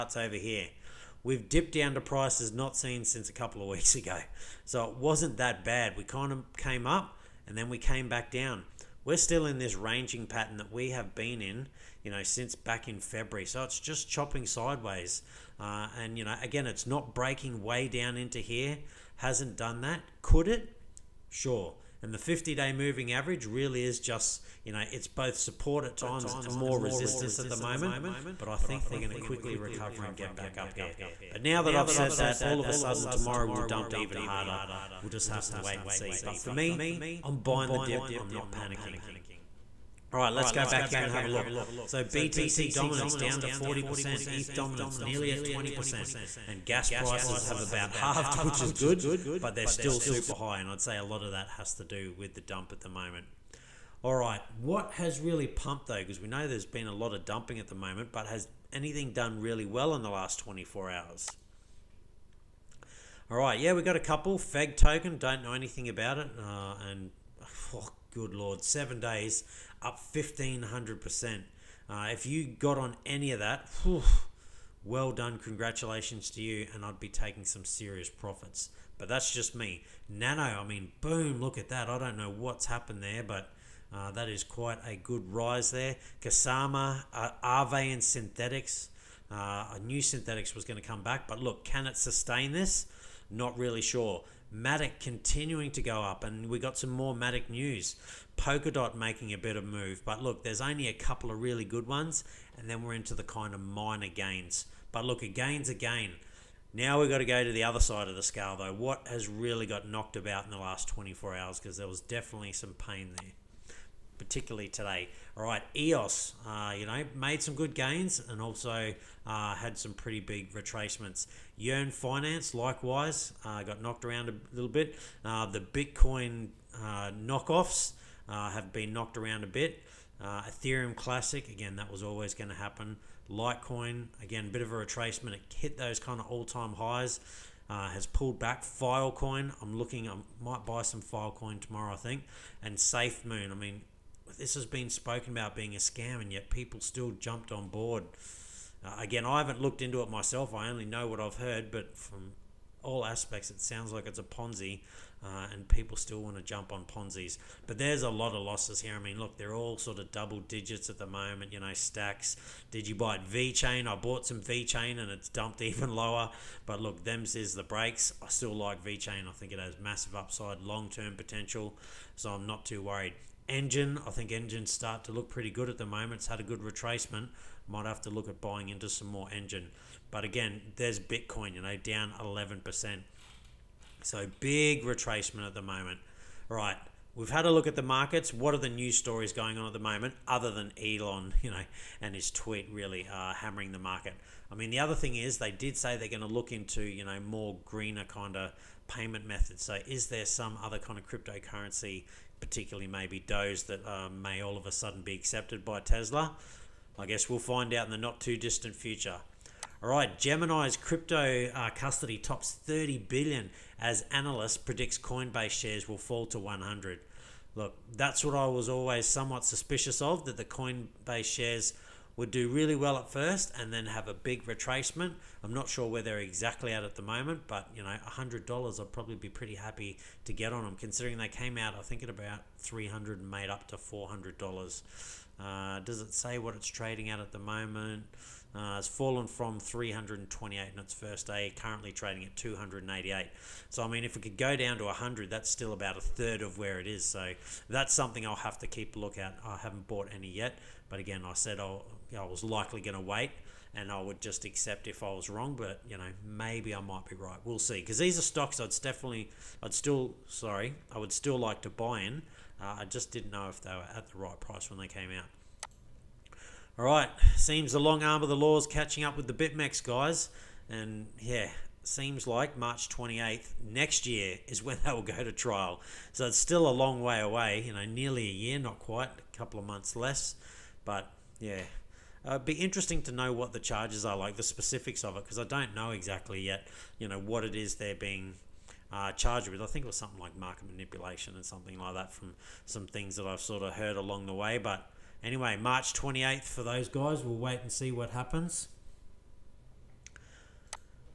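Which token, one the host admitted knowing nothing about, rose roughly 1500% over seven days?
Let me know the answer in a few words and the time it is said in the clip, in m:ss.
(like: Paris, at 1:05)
Fag token, at 1:04.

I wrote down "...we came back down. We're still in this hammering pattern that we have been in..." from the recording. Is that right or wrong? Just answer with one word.
wrong.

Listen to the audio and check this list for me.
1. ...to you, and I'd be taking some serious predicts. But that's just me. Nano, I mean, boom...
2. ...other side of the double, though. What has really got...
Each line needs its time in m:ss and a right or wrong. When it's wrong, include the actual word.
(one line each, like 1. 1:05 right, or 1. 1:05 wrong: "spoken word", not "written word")
1. 1:16 wrong: "profits", not "predicts"
2. 1:47 wrong: "scale", not "double".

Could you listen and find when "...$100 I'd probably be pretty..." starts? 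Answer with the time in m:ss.
3:48.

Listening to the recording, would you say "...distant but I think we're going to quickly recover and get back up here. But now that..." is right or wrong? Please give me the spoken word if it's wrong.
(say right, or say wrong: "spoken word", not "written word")
wrong: "moment", not "distant".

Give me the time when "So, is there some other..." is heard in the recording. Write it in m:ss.
3:19.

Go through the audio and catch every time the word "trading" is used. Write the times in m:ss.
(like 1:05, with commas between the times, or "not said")
3:56, 4:01.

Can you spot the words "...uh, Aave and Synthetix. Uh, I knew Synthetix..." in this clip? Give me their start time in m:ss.
1:27.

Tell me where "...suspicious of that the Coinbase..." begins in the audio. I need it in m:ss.
3:39.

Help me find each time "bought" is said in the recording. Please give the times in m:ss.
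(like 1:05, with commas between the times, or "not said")
2:43, 4:09.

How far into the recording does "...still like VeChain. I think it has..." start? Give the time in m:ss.
2:48.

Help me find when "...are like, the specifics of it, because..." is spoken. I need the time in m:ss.
4:44.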